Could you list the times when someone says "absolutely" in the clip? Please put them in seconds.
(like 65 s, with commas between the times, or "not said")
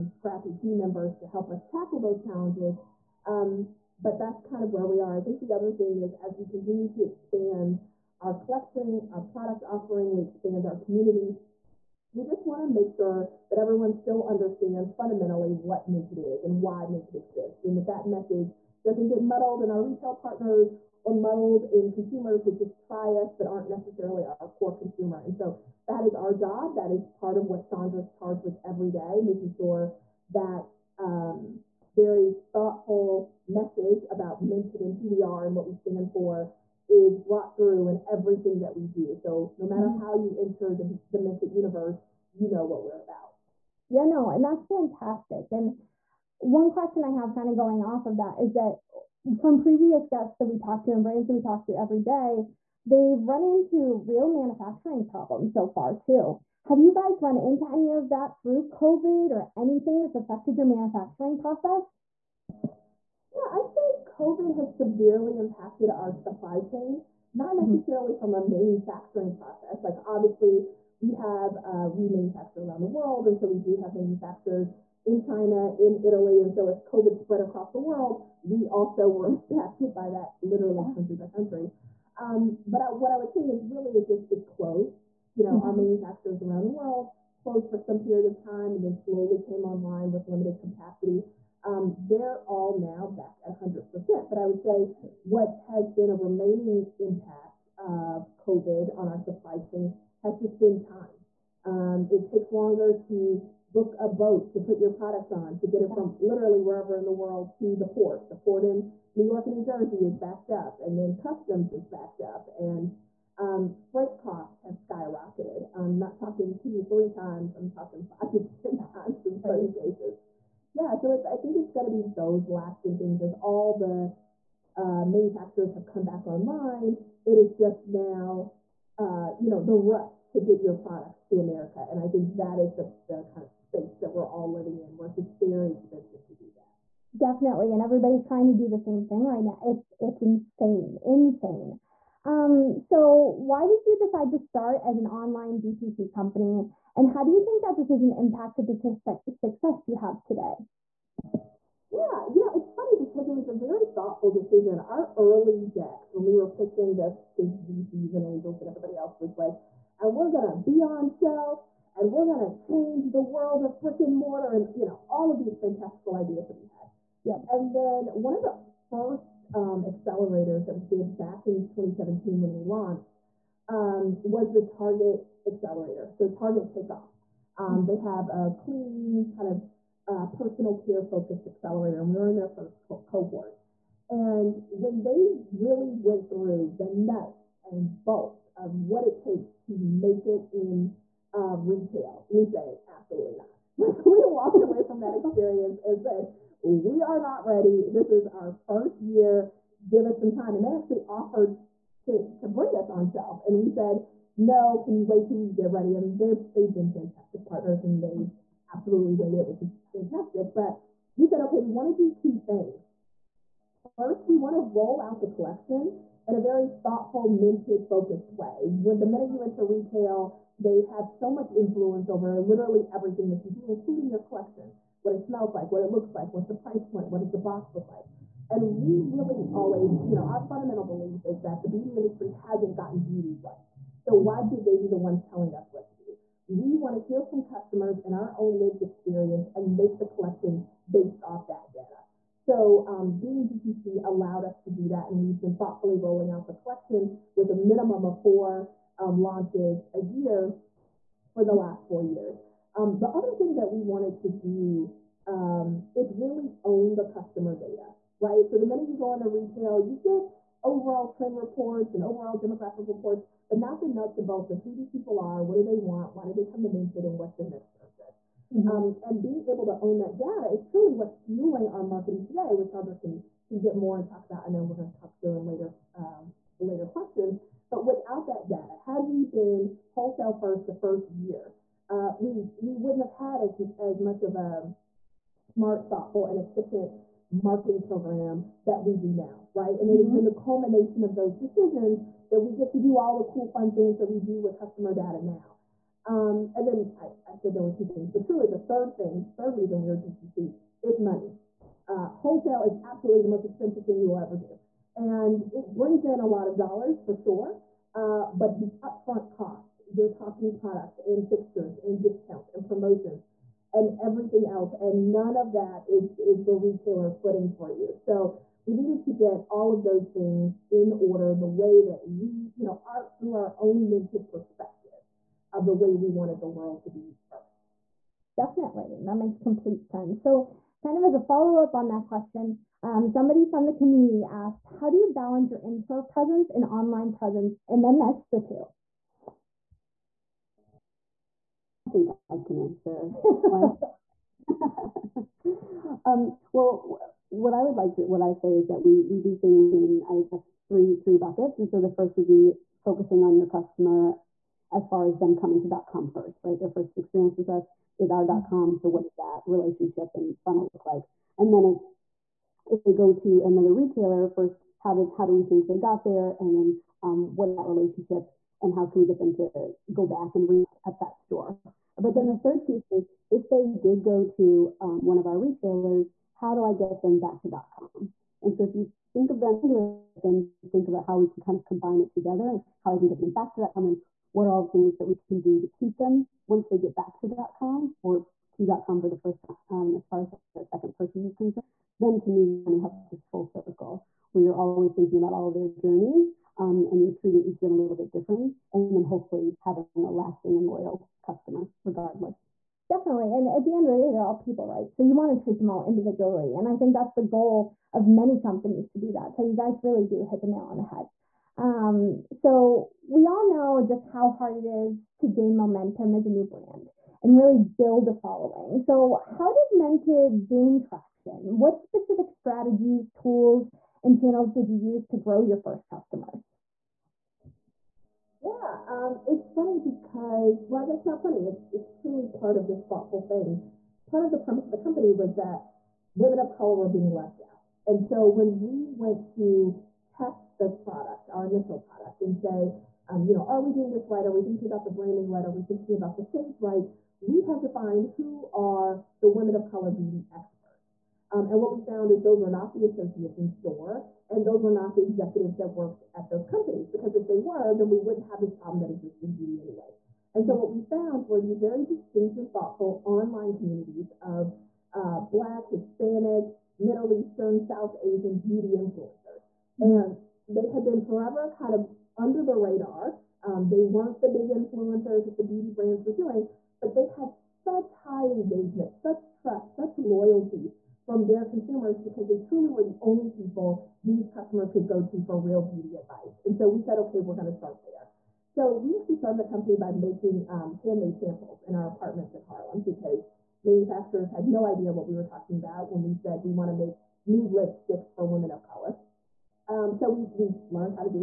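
192 s, 208 s, 302 s.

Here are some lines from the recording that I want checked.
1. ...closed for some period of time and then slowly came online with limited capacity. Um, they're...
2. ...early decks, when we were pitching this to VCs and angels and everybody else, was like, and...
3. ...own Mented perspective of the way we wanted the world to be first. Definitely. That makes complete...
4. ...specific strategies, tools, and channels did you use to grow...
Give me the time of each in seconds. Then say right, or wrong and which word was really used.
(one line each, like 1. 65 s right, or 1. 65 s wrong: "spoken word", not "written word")
1. 87 s right
2. 155 s right
3. 323 s right
4. 421 s right.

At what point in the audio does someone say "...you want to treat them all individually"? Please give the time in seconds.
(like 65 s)
405 s.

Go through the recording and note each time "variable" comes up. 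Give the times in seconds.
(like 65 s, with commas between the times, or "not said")
not said.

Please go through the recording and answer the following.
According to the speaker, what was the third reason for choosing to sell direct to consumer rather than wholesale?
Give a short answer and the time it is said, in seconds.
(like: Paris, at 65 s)
Money, at 301 s.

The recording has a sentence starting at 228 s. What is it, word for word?
And we really always, you know, our fundamental belief is that the beauty industry hasn't gotten beauty right.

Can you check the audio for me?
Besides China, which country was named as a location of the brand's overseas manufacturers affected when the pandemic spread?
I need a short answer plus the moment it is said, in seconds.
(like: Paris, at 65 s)
Italy, at 76 s.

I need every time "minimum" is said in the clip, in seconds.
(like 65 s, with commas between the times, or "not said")
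247 s.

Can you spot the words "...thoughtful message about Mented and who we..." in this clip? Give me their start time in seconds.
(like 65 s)
32 s.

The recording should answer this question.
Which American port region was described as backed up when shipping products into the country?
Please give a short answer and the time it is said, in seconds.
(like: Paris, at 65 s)
New York and New Jersey, at 109 s.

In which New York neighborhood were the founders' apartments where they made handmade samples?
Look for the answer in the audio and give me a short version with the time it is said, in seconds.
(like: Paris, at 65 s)
Harlem, at 492 s.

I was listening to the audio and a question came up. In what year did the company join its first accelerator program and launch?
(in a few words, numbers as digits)
2017.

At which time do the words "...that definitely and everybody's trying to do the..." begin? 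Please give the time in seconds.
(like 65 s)
136 s.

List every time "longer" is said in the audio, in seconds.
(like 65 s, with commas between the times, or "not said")
102 s.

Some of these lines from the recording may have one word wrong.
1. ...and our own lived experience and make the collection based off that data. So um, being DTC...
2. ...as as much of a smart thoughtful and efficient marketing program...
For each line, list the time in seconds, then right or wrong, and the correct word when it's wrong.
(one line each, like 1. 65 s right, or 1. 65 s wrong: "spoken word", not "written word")
1. 238 s right
2. 283 s right.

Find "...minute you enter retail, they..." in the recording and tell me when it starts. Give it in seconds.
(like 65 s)
219 s.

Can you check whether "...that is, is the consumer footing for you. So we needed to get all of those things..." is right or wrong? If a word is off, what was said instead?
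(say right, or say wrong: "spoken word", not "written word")
wrong: "retailer", not "consumer".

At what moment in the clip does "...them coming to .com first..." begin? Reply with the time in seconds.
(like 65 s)
355 s.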